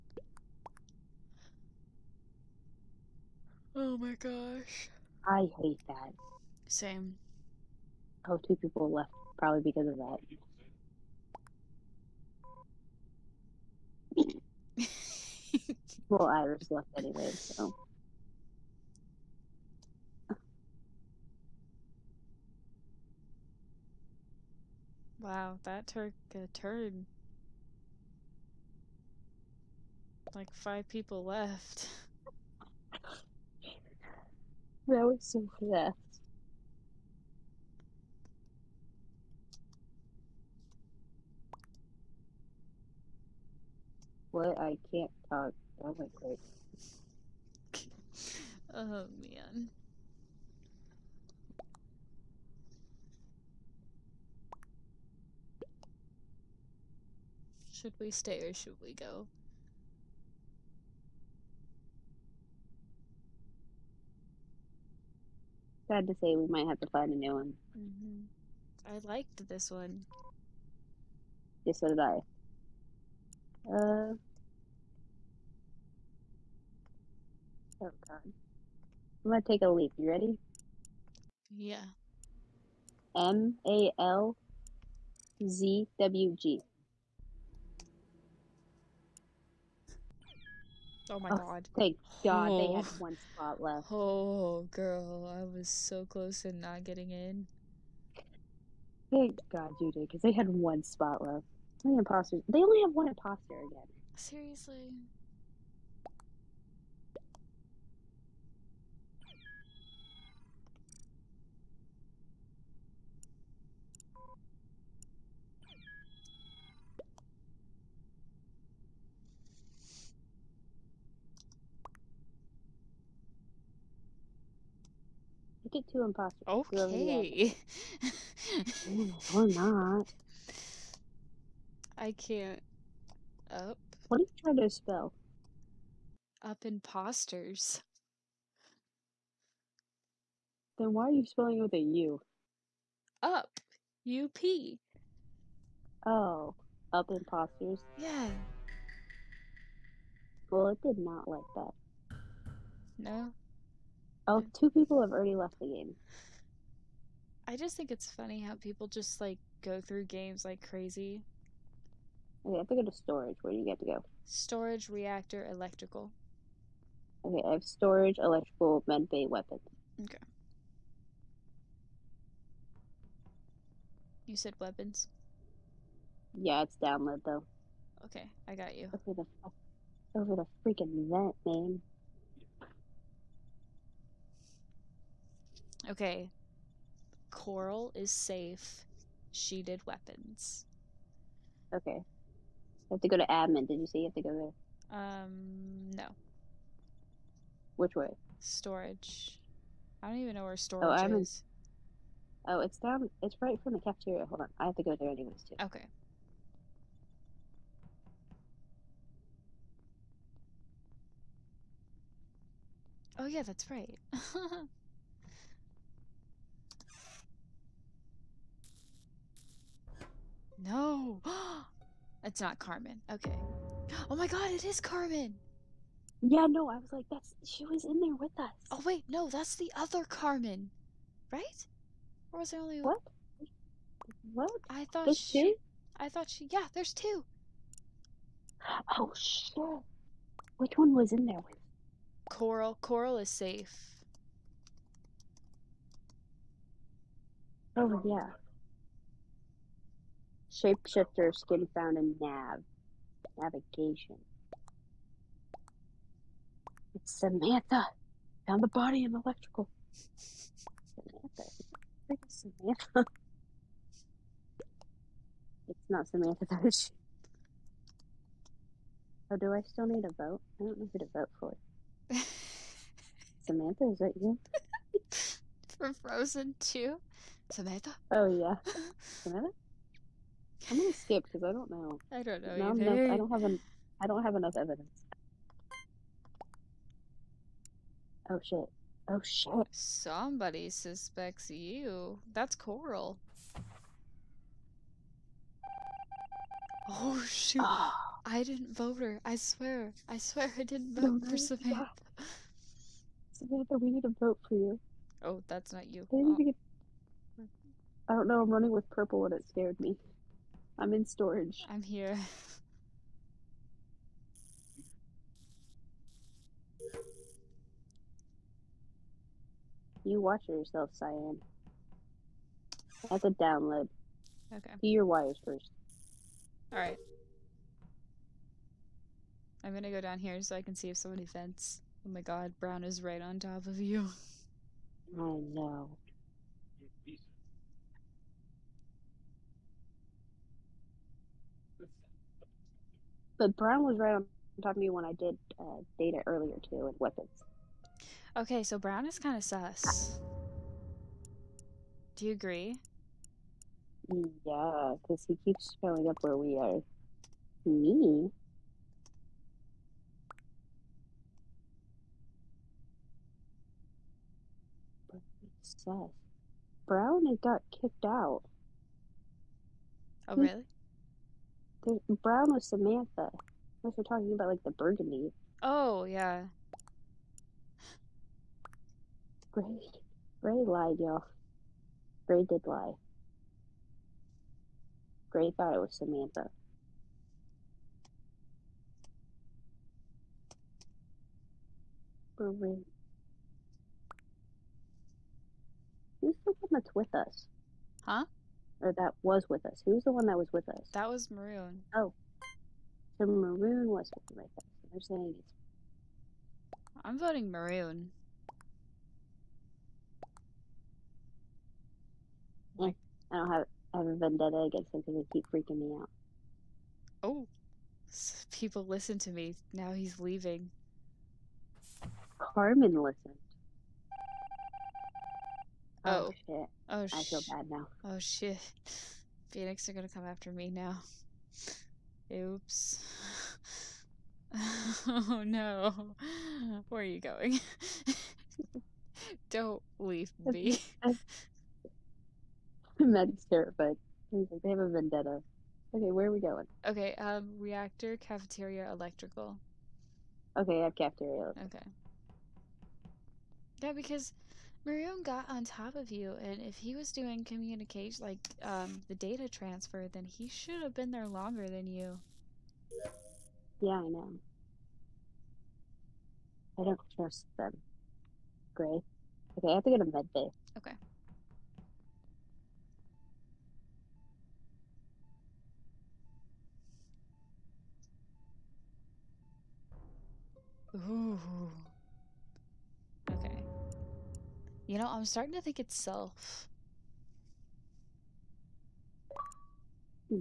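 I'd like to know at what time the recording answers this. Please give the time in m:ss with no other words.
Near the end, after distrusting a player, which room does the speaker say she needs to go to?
7:50.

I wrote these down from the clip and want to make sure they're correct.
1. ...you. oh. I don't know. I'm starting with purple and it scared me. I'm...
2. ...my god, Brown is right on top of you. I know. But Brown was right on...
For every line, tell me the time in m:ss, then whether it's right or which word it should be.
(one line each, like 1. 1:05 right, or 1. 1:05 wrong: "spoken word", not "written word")
1. 5:05 wrong: "running", not "starting"
2. 5:32 right.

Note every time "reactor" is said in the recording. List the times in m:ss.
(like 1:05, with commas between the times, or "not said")
2:44, 7:27.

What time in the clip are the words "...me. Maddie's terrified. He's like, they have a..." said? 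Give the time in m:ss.
7:20.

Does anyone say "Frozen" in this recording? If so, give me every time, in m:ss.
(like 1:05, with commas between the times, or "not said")
4:35.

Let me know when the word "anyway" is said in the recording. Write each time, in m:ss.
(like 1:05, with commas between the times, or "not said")
0:16, 3:25.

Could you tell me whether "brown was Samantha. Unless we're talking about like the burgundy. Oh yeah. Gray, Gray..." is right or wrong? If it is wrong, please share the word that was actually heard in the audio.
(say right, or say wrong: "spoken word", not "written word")
right.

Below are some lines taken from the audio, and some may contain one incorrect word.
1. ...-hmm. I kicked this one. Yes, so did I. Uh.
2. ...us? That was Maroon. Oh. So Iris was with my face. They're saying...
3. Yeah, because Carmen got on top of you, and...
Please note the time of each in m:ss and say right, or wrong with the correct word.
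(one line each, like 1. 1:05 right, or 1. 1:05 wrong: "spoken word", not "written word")
1. 1:07 wrong: "liked", not "kicked"
2. 6:40 wrong: "Maroon", not "Iris"
3. 7:33 wrong: "Maroon", not "Carmen".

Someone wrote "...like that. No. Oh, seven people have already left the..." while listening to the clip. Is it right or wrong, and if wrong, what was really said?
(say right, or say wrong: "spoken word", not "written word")
wrong: "two", not "seven".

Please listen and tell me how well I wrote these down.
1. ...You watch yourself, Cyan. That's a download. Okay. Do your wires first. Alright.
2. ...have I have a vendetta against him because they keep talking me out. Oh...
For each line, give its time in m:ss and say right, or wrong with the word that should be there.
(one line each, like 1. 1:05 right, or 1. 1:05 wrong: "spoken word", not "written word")
1. 5:20 right
2. 6:53 wrong: "freaking", not "talking".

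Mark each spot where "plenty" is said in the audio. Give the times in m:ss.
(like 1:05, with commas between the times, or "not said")
not said.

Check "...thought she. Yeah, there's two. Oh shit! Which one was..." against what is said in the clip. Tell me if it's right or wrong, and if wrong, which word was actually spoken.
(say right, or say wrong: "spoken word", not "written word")
right.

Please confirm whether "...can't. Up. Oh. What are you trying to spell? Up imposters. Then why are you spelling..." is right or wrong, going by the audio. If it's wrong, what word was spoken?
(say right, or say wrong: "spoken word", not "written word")
right.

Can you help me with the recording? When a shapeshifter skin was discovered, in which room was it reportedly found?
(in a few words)
Navigation.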